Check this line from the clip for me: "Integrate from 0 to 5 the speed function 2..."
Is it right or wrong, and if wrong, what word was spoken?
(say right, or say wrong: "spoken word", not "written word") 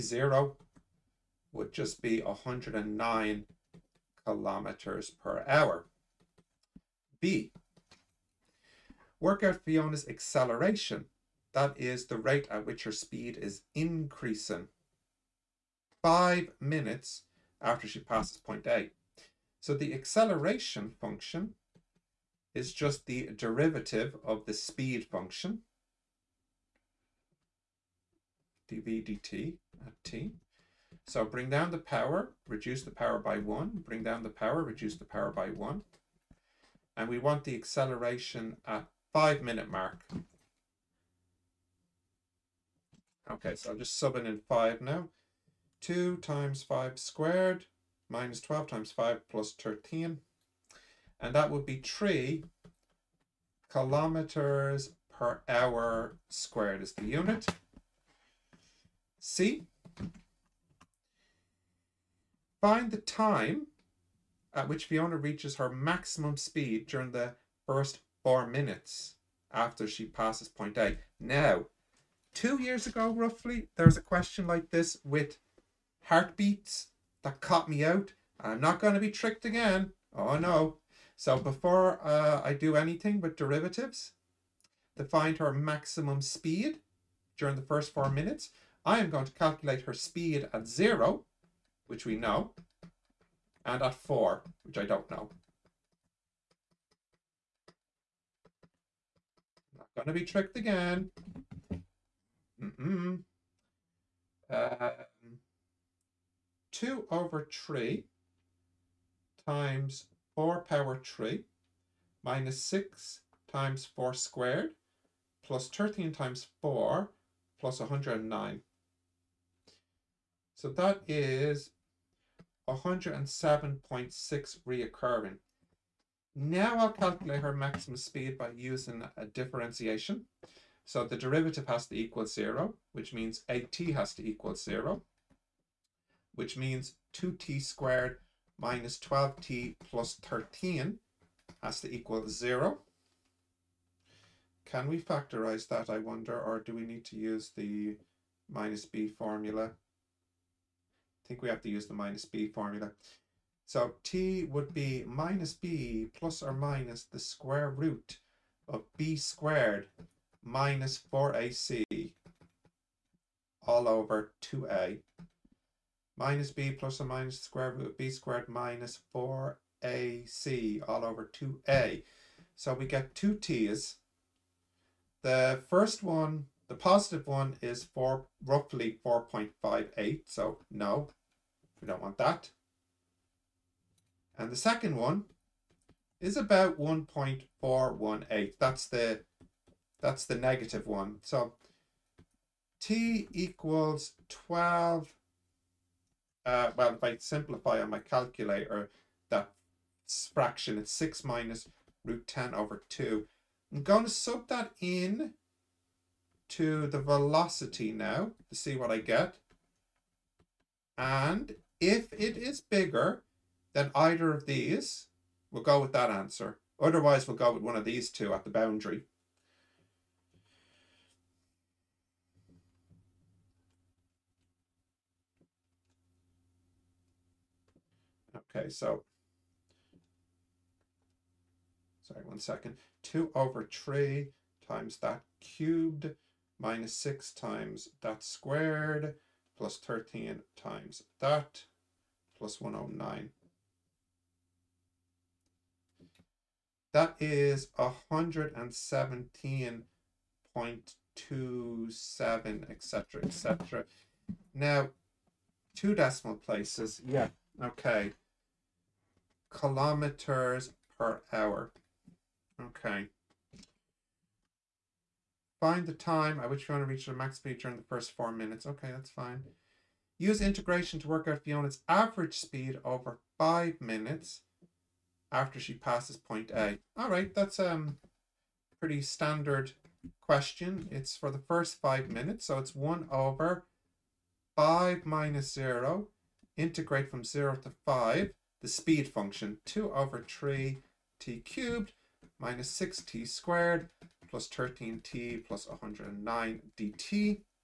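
right.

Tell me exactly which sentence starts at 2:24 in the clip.
Can we factorize that, I wonder, or do we need to use the minus b formula?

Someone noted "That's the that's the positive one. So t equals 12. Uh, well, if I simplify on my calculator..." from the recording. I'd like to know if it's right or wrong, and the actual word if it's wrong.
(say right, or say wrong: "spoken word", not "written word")
wrong: "negative", not "positive".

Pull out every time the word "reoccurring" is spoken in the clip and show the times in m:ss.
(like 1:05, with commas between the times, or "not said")
2:04.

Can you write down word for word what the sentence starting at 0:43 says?
Okay, so I'm just subbing in 5 now.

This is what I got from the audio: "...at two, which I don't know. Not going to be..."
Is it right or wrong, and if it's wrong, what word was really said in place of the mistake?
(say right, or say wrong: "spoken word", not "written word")
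wrong: "four", not "two".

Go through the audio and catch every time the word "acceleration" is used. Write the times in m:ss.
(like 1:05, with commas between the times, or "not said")
0:10, 0:19, 0:37.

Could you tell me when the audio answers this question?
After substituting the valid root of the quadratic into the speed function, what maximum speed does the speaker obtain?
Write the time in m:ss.
4:07.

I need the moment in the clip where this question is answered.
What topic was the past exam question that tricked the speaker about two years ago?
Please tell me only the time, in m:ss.
1:16.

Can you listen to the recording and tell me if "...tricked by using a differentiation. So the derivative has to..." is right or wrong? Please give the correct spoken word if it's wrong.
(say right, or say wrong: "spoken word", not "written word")
wrong: "speed", not "tricked".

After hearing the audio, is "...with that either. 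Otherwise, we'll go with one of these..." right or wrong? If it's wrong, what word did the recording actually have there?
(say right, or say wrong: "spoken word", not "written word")
wrong: "answer", not "either".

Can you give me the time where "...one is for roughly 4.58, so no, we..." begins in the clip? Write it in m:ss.
2:57.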